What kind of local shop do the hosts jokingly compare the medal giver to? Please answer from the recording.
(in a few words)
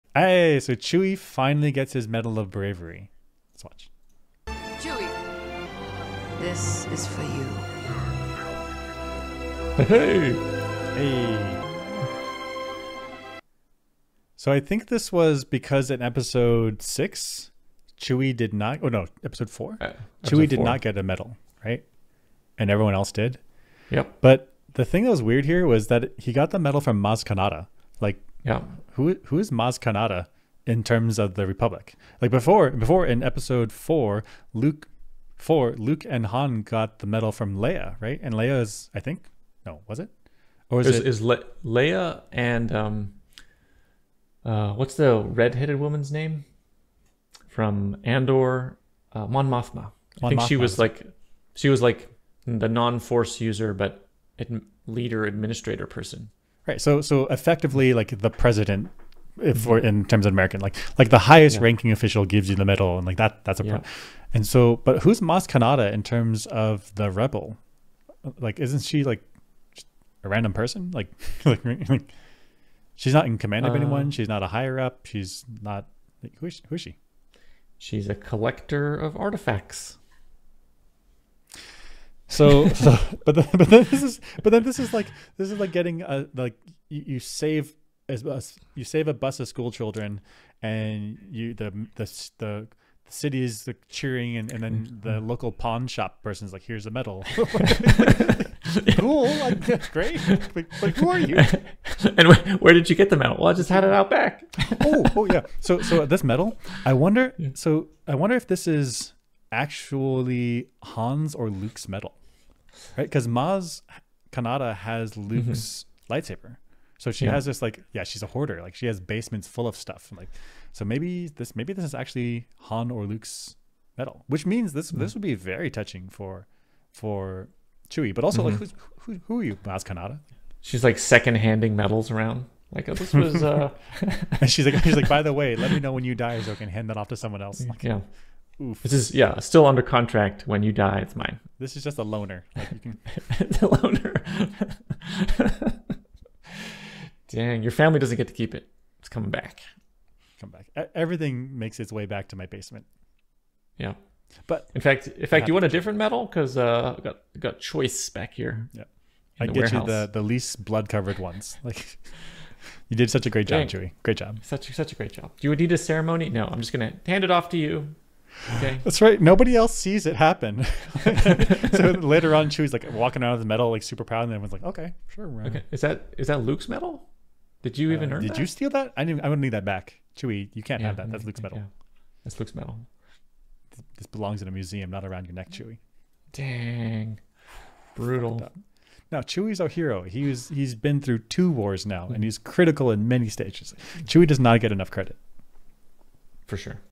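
pawn shop.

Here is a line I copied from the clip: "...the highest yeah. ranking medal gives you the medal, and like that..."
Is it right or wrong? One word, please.
wrong.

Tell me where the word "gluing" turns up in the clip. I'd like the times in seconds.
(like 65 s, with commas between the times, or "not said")
not said.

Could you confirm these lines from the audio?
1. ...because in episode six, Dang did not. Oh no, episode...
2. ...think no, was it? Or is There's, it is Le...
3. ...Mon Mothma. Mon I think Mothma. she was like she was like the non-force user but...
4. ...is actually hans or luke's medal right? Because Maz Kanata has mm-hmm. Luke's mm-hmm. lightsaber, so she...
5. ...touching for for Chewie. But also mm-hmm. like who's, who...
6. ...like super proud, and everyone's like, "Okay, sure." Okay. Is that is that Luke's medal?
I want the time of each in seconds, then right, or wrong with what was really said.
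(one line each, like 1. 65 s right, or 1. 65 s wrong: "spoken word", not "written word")
1. 15 s wrong: "Chewie", not "Dang"
2. 38 s right
3. 49 s right
4. 108 s right
5. 125 s right
6. 173 s right.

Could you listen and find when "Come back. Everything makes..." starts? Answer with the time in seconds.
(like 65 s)
150 s.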